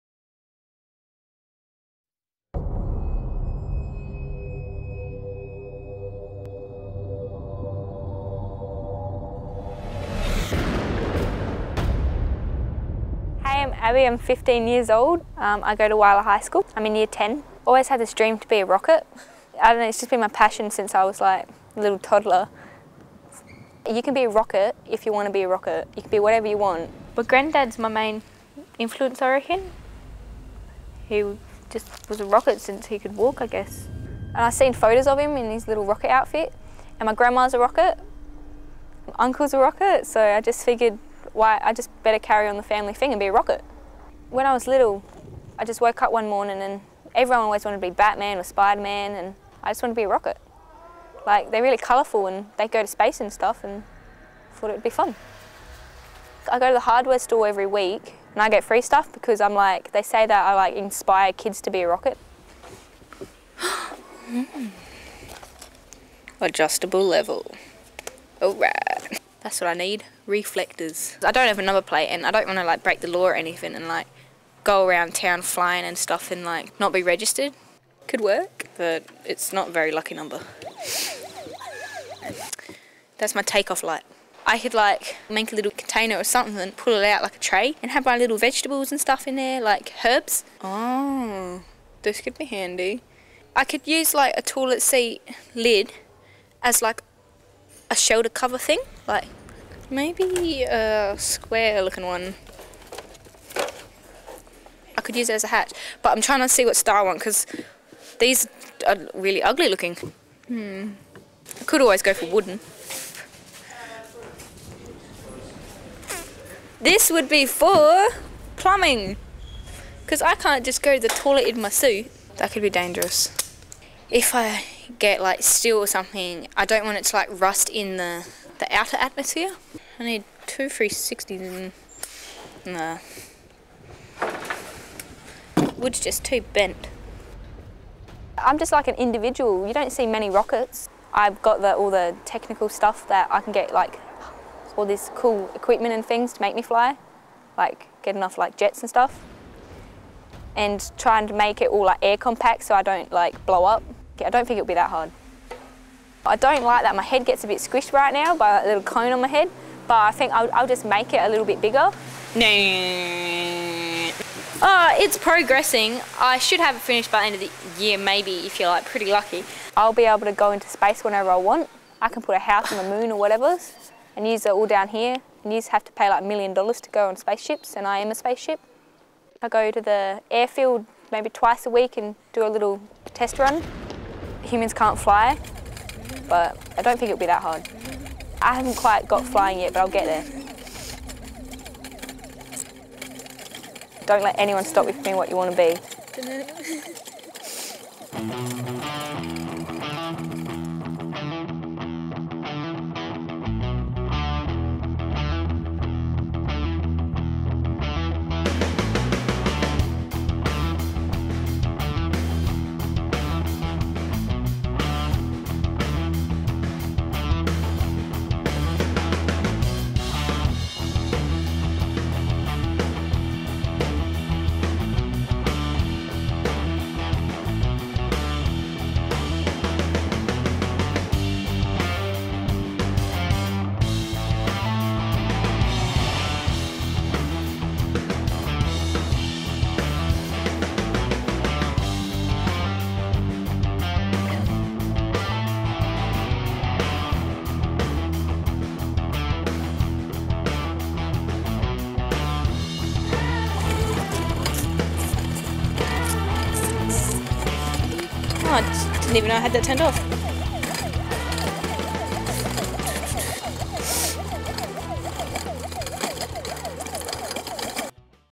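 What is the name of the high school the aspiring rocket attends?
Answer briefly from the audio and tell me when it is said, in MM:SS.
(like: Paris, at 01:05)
Whyalla High School, at 00:15.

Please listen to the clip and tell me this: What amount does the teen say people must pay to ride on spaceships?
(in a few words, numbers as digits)
a million dollars.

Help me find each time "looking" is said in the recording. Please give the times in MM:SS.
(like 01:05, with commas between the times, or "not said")
01:41, 01:49.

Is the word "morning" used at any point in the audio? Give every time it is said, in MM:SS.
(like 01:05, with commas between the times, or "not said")
00:46.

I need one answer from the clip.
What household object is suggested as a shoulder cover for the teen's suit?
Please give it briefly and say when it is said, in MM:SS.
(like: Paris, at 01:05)
toilet seat lid, at 01:34.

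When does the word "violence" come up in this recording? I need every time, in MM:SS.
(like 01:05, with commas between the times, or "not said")
not said.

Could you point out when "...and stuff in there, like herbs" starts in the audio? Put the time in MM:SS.
01:28.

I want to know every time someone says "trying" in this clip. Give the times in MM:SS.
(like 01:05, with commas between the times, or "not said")
01:46, 02:30.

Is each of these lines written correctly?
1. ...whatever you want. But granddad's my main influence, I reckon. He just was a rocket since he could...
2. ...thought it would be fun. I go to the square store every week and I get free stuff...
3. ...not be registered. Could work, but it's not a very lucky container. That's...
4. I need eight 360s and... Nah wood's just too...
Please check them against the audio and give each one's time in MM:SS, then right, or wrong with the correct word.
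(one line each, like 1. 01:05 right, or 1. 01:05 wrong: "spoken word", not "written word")
1. 00:26 right
2. 00:54 wrong: "hardware", not "square"
3. 01:16 wrong: "number", not "container"
4. 02:09 wrong: "two", not "eight".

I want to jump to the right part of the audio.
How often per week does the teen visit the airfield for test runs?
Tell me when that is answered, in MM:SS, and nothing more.
03:01.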